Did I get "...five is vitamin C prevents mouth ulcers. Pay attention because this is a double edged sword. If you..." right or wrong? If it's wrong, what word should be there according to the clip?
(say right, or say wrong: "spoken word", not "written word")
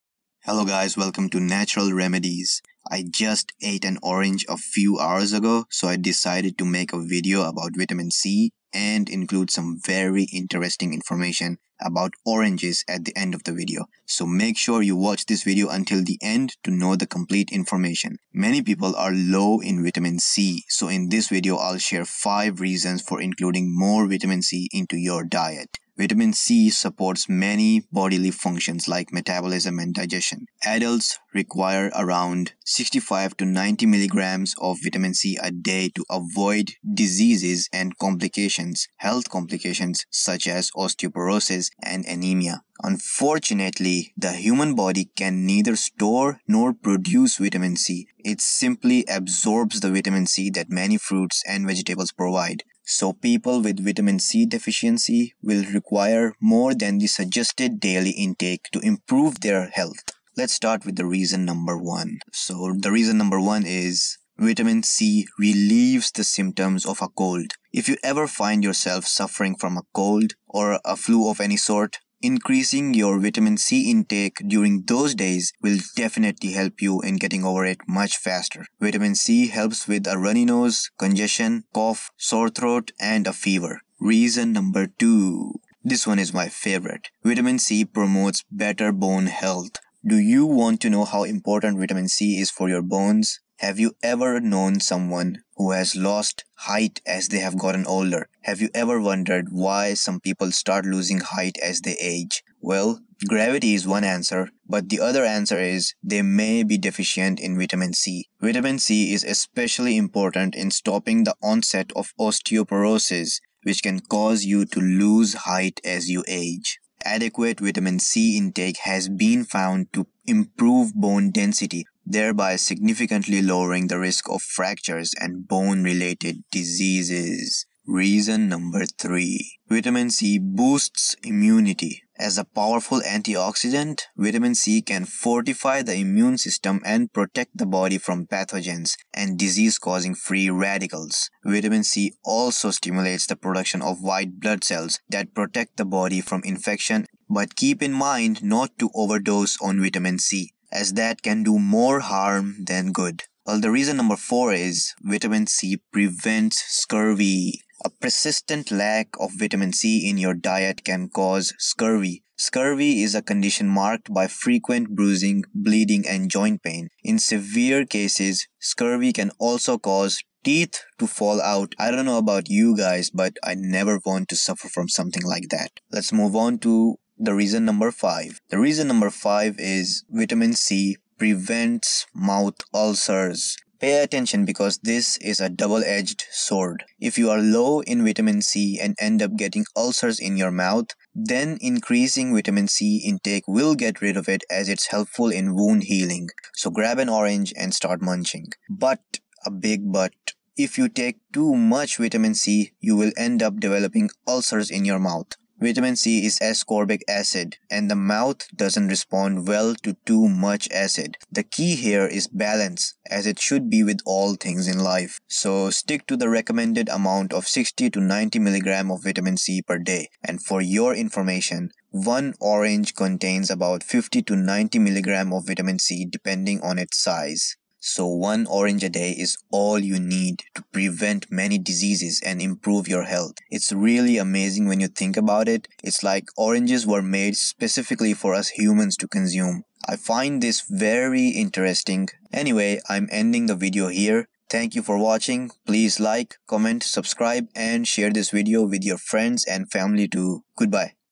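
right.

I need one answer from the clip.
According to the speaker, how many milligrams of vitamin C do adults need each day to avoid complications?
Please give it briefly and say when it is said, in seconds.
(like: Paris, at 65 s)
65 to 90 milligrams, at 32 s.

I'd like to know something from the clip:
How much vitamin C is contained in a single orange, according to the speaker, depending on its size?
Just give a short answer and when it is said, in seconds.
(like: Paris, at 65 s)
50 to 90 milligrams, at 223 s.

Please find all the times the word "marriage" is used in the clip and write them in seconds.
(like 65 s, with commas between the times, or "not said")
not said.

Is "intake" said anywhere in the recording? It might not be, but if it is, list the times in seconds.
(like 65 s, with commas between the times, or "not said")
58 s, 73 s, 118 s, 193 s.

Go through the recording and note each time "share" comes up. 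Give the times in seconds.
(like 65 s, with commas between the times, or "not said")
21 s, 247 s.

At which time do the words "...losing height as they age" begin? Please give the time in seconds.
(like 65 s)
100 s.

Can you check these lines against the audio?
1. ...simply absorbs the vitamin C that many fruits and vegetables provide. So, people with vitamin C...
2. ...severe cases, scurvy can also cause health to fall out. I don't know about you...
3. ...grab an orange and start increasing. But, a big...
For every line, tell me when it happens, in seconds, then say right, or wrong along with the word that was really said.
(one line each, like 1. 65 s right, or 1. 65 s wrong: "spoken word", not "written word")
1. 48 s right
2. 167 s wrong: "teeth", not "health"
3. 196 s wrong: "munching", not "increasing".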